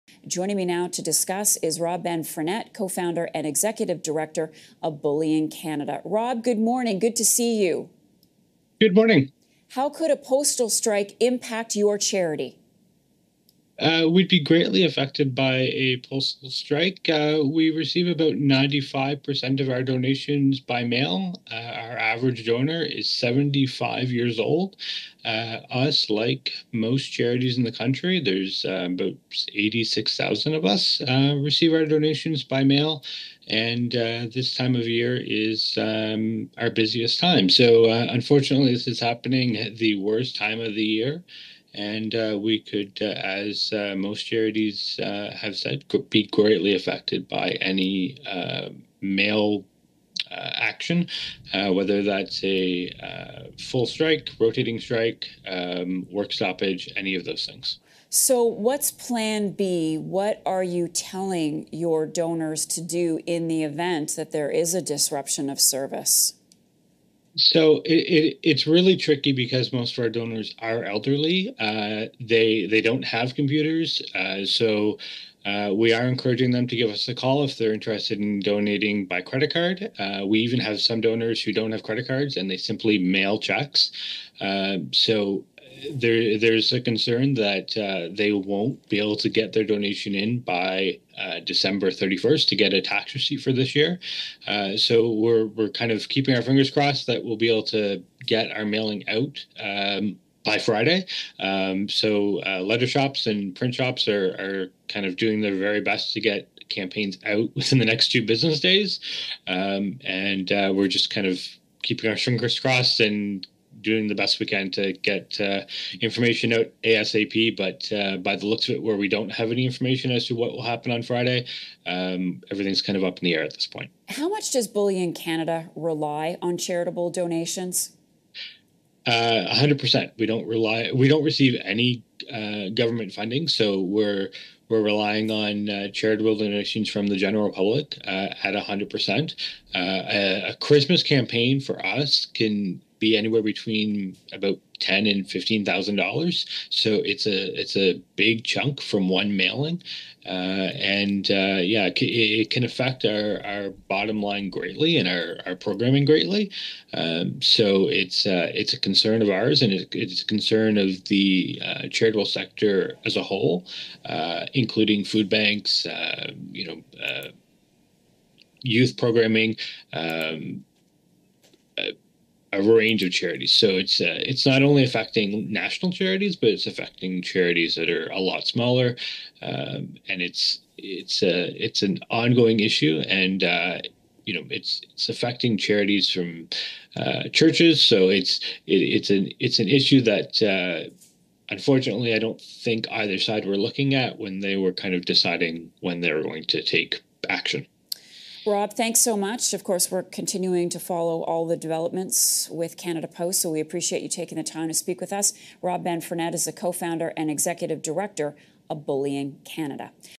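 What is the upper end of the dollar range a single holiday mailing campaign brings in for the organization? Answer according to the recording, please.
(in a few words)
$15,000.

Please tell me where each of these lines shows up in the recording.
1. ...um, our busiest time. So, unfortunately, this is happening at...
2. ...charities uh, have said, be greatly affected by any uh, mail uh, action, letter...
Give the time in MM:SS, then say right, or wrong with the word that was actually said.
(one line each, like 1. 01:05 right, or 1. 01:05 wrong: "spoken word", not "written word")
1. 00:35 right
2. 00:44 wrong: "whether", not "letter".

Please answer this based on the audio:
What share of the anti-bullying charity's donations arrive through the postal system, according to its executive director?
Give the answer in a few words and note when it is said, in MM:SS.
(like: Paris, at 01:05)
95%, at 00:18.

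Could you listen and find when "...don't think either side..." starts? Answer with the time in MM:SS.
03:12.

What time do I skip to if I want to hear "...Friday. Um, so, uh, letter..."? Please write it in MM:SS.
01:40.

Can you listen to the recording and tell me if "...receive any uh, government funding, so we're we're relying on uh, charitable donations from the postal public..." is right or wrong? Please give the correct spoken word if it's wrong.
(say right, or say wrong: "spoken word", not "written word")
wrong: "general", not "postal".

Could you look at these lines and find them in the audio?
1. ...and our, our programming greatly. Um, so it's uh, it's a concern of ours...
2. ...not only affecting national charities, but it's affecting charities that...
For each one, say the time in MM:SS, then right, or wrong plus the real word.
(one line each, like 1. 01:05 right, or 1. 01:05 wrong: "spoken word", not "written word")
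1. 02:34 right
2. 02:54 right.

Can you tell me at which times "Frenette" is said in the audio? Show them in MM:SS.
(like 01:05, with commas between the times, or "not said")
00:02, 03:25.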